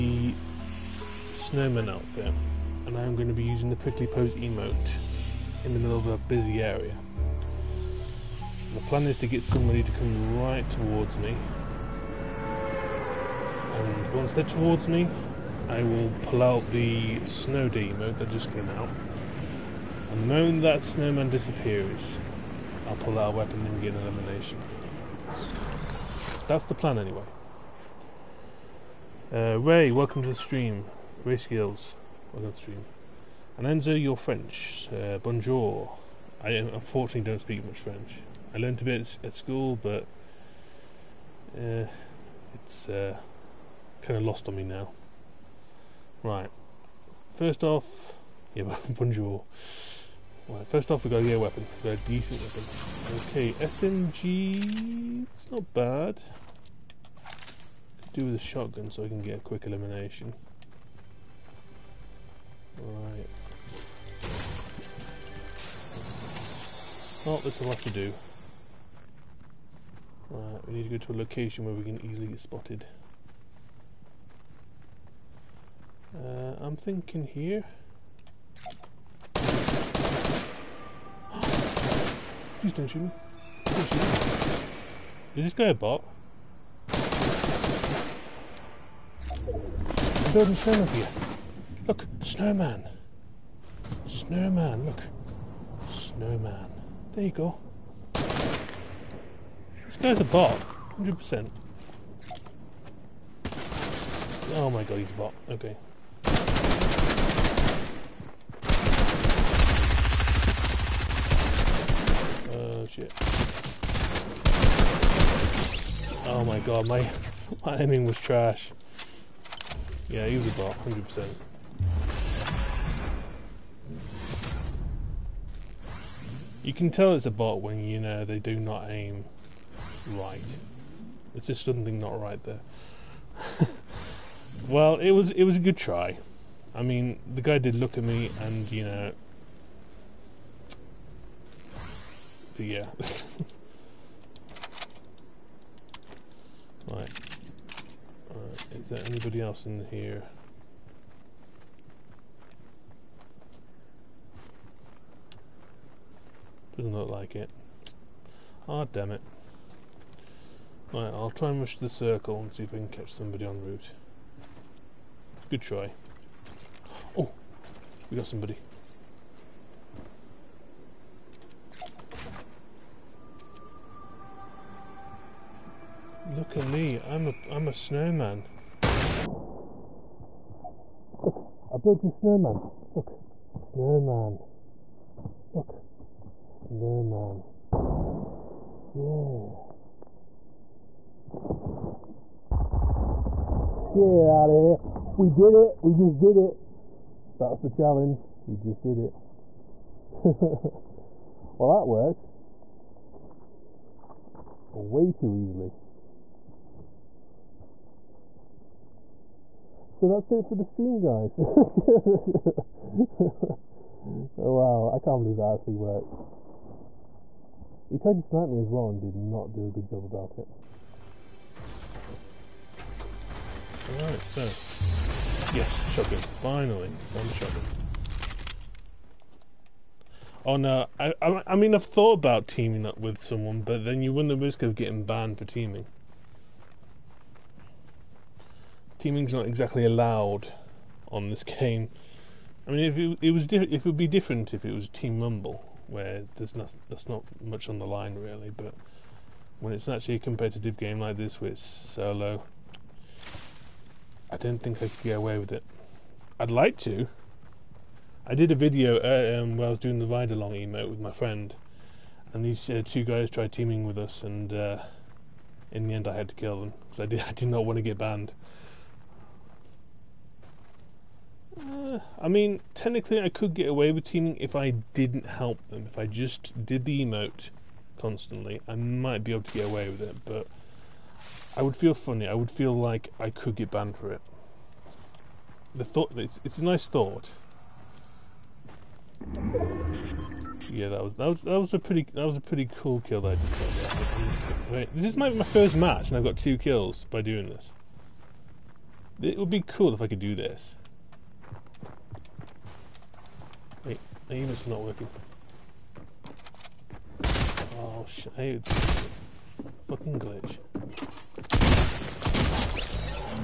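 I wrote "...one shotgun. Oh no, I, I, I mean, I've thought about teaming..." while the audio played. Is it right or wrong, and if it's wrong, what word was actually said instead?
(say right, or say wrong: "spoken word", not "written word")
right.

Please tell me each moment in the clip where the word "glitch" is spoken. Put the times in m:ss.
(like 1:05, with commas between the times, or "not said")
5:10.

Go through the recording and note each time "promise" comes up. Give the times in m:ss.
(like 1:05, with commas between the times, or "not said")
not said.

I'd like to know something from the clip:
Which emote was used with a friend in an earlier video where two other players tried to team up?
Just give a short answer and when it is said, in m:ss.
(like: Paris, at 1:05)
ride along, at 4:20.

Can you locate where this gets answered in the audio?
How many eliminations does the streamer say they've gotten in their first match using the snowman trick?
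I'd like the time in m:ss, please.
4:56.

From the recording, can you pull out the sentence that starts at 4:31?
Uh, I mean, technically, I could get away with teaming if I didn't help them.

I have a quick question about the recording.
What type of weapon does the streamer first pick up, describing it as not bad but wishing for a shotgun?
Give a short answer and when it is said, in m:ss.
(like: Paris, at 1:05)
SMG, at 0:53.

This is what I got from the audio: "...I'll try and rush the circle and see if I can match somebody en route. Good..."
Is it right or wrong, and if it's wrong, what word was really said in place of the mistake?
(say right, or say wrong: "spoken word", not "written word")
wrong: "catch", not "match".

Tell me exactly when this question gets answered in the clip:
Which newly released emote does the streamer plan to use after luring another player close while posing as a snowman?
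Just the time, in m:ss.
0:17.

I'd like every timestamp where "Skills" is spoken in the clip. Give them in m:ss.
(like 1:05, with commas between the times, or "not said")
0:31.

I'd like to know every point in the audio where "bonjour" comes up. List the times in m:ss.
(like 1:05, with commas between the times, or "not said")
0:35, 0:48.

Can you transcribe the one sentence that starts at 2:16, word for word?
I mean, the guy did look at me, and you know, yeah.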